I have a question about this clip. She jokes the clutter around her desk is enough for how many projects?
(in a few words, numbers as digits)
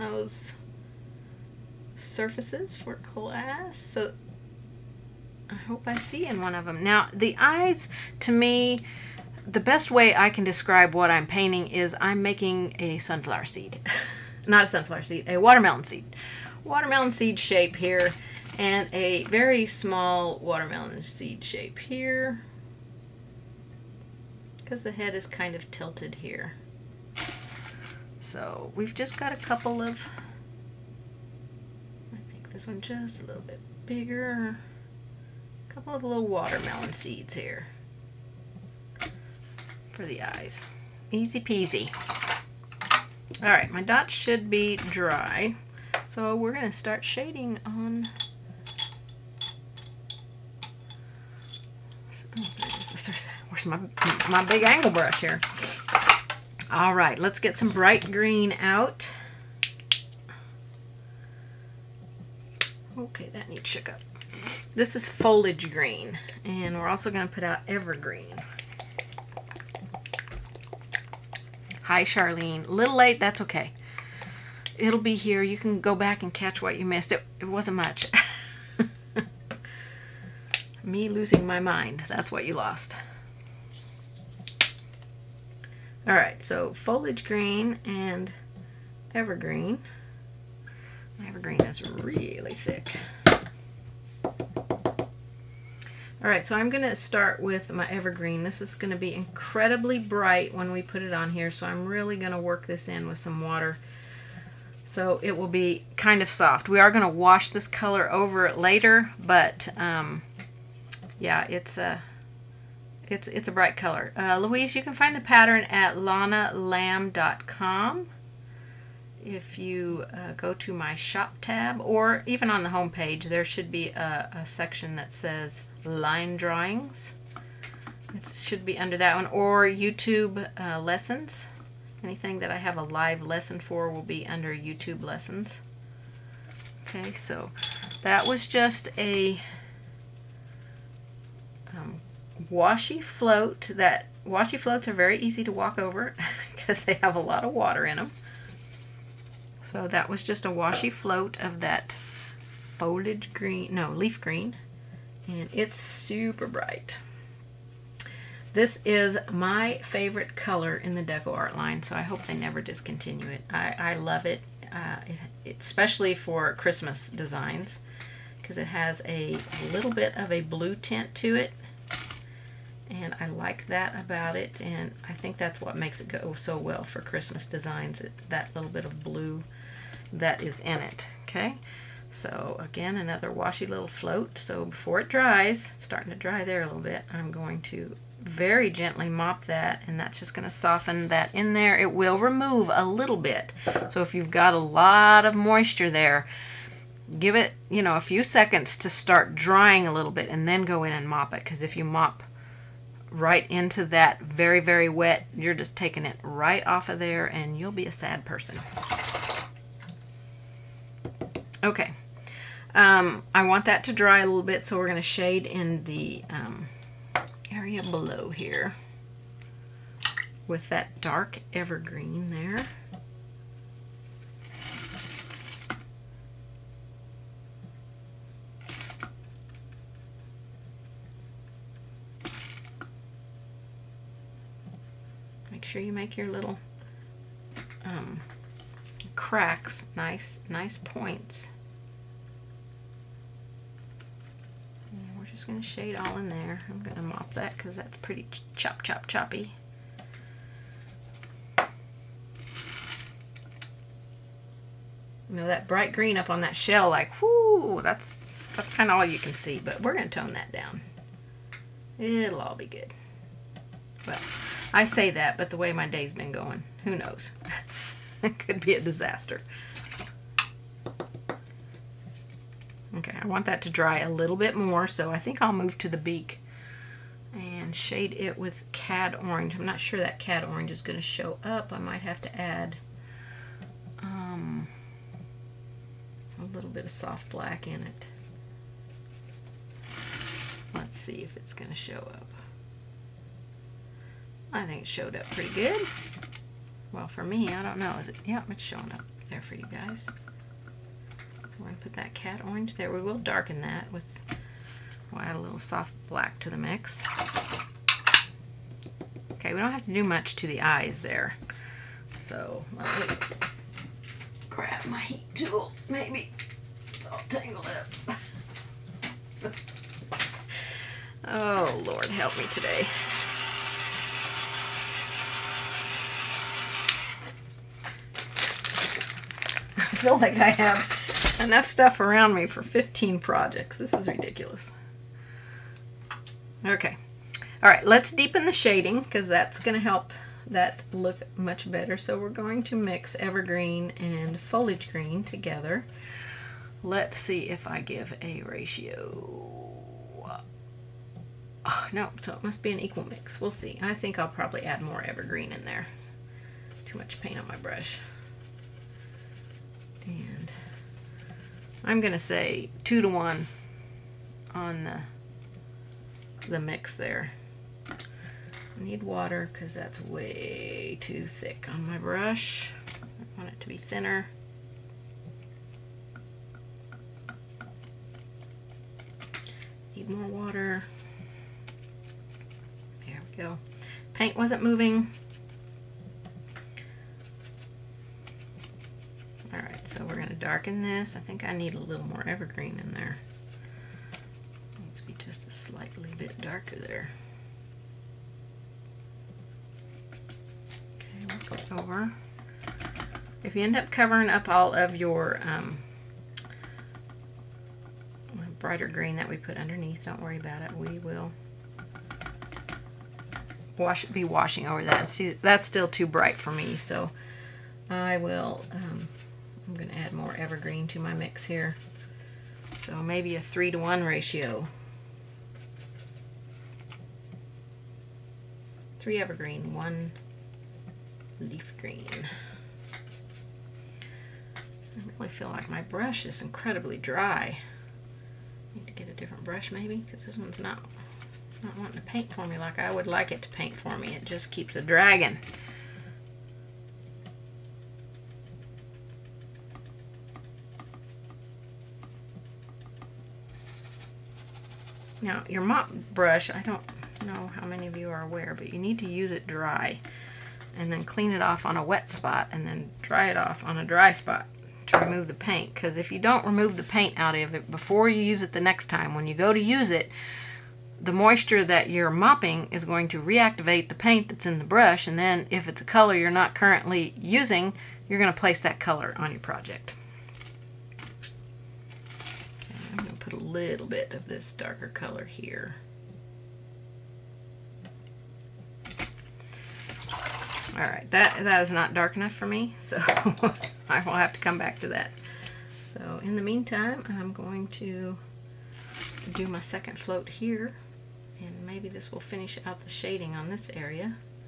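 15.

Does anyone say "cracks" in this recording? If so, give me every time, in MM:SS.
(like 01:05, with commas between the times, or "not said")
03:59.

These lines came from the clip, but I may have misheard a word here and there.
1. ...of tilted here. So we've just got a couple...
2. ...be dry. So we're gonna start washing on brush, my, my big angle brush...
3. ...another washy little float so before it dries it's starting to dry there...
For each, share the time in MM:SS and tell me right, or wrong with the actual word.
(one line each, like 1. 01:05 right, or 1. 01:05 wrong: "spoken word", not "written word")
1. 00:25 right
2. 00:44 wrong: "shading", not "washing"
3. 03:02 right.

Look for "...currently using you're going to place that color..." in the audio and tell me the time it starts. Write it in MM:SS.
07:56.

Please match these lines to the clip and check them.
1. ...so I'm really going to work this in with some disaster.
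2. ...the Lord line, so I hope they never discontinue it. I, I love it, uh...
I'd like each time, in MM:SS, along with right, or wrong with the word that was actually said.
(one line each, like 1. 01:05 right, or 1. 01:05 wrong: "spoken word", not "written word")
1. 01:41 wrong: "water", not "disaster"
2. 02:40 wrong: "DecoArt", not "Lord".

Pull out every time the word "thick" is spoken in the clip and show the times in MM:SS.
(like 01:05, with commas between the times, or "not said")
01:32, 06:11.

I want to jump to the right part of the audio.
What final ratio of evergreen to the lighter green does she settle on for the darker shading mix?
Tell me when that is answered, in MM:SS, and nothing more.
07:03.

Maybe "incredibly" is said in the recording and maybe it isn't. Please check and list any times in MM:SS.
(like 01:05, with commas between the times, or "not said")
01:39, 07:16.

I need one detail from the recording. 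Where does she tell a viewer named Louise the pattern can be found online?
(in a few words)
lonnalamb.com.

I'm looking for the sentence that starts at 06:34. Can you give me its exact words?
It needs to be just a slightly bit darker there.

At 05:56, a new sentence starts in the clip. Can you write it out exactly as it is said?
Too much paint on my brush.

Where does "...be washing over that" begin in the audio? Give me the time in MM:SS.
06:54.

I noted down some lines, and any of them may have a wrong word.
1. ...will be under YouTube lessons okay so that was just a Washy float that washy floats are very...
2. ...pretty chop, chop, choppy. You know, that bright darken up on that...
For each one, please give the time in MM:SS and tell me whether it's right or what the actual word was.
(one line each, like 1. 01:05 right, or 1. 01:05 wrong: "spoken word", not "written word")
1. 02:13 right
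2. 04:07 wrong: "green", not "darken".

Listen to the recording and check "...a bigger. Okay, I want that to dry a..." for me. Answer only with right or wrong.
wrong.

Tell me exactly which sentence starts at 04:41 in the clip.
I might have to add um, a little bit of soft black in it.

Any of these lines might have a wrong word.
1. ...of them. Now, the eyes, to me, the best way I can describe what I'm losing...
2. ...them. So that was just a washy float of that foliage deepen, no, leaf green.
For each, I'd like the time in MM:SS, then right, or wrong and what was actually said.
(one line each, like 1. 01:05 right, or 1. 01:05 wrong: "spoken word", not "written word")
1. 00:06 wrong: "painting", not "losing"
2. 02:27 wrong: "green", not "deepen".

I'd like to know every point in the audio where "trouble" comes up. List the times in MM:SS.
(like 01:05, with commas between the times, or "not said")
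not said.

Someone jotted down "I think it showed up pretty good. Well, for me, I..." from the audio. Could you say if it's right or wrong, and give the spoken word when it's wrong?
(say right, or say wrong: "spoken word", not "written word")
right.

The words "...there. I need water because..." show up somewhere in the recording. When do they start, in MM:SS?
06:06.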